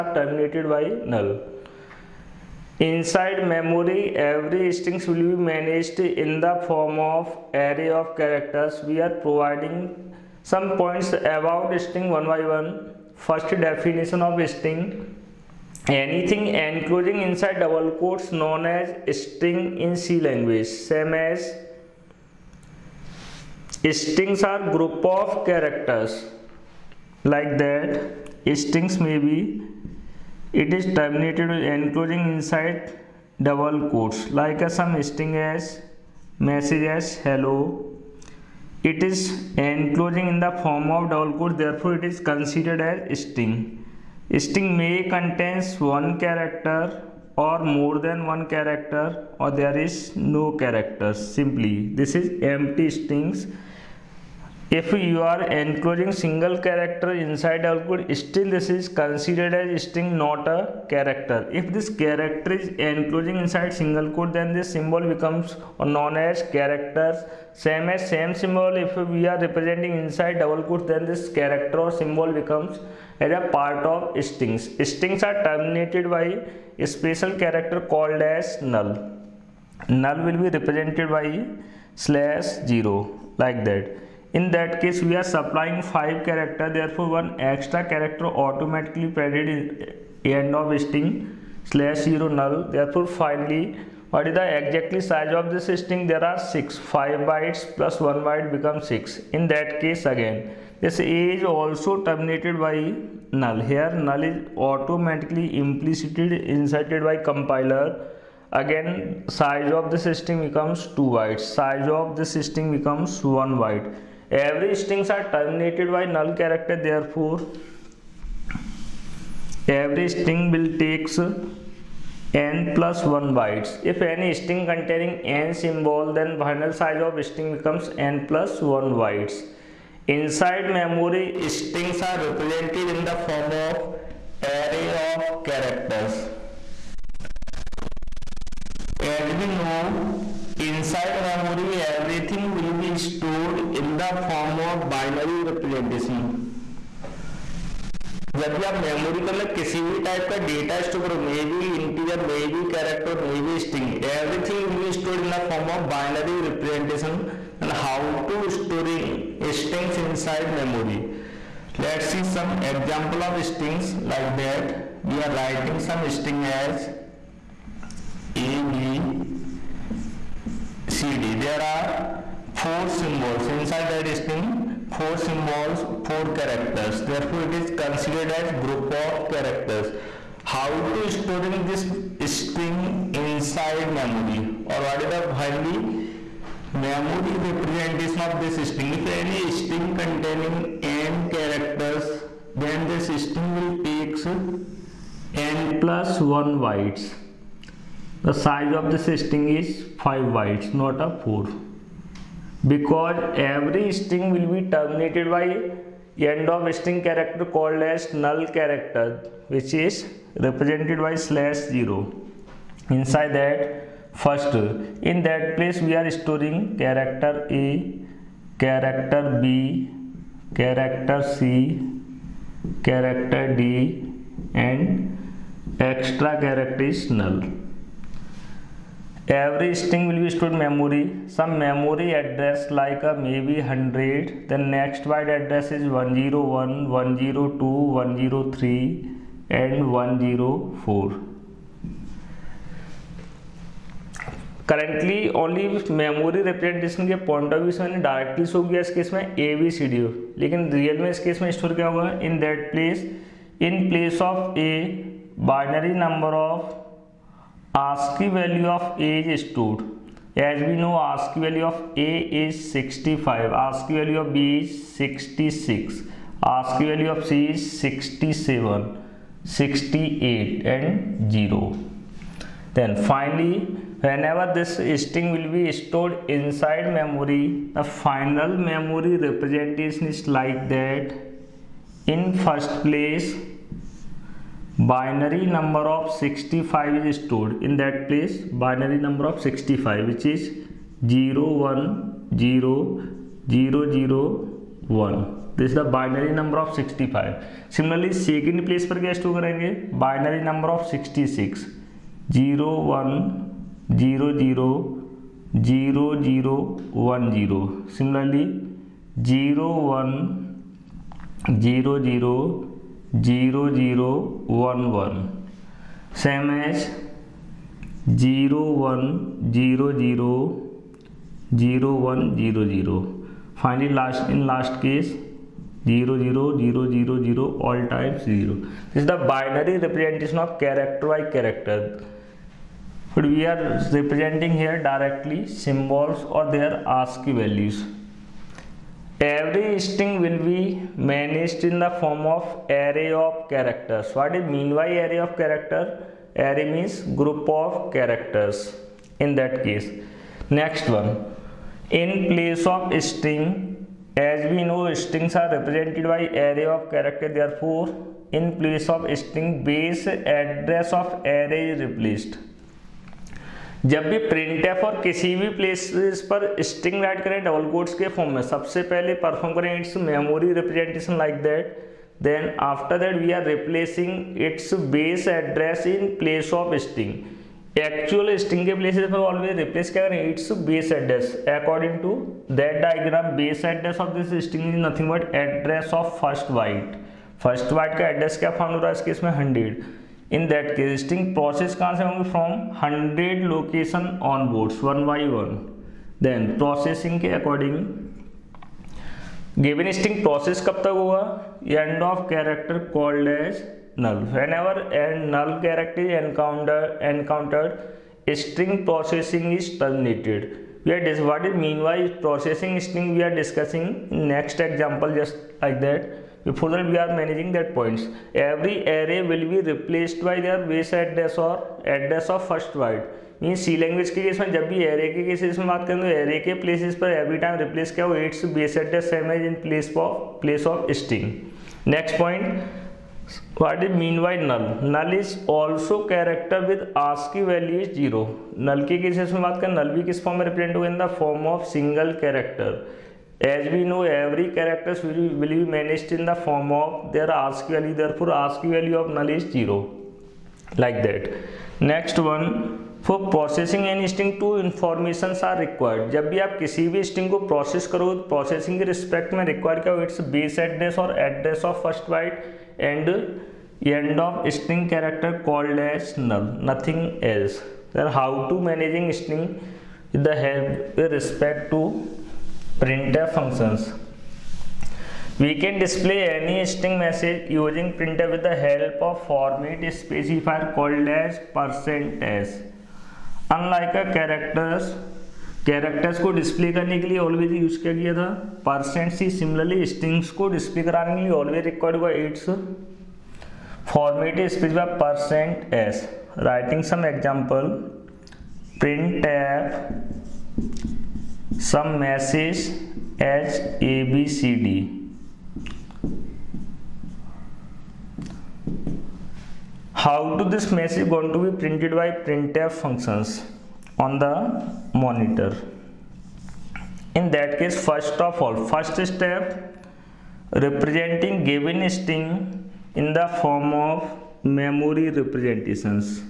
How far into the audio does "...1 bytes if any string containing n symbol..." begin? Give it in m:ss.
2:03.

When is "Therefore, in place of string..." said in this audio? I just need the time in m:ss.
5:57.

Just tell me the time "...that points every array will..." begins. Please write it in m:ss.
6:57.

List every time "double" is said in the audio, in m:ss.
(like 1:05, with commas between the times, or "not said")
0:17, 0:33, 0:41, 1:10.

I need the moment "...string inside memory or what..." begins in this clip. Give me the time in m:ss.
3:02.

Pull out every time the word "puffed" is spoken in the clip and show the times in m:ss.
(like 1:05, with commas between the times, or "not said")
not said.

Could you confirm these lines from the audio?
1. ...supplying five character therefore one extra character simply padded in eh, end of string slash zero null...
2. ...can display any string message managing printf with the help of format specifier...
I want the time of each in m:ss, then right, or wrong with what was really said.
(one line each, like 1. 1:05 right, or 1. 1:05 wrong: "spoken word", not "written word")
1. 1:25 wrong: "automatically", not "simply"
2. 7:55 wrong: "using", not "managing".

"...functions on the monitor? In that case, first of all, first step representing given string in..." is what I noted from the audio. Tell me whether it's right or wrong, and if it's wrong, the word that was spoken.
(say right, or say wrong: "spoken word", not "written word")
right.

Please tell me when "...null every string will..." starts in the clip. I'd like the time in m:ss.
3:47.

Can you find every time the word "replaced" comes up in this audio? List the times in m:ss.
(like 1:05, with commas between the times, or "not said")
6:01, 6:59.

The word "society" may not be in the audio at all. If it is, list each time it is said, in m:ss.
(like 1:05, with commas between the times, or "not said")
not said.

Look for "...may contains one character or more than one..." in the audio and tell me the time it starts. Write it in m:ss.
0:44.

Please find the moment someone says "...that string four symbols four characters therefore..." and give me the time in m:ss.
2:53.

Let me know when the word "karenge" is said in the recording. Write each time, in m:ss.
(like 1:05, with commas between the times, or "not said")
4:59.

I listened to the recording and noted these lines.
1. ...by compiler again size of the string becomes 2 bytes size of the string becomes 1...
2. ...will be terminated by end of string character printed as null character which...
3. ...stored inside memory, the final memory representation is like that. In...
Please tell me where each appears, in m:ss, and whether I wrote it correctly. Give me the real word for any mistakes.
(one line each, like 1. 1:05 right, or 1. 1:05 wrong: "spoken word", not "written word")
1. 1:47 right
2. 3:24 wrong: "called", not "printed"
3. 4:35 right.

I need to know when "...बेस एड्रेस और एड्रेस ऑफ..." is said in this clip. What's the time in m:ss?
7:40.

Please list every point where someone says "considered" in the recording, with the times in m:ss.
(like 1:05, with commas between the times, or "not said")
0:42, 0:58, 2:57.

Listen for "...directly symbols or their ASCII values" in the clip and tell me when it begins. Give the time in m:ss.
5:34.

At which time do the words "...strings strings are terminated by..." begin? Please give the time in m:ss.
1:14.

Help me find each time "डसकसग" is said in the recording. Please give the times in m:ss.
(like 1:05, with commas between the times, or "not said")
6:53.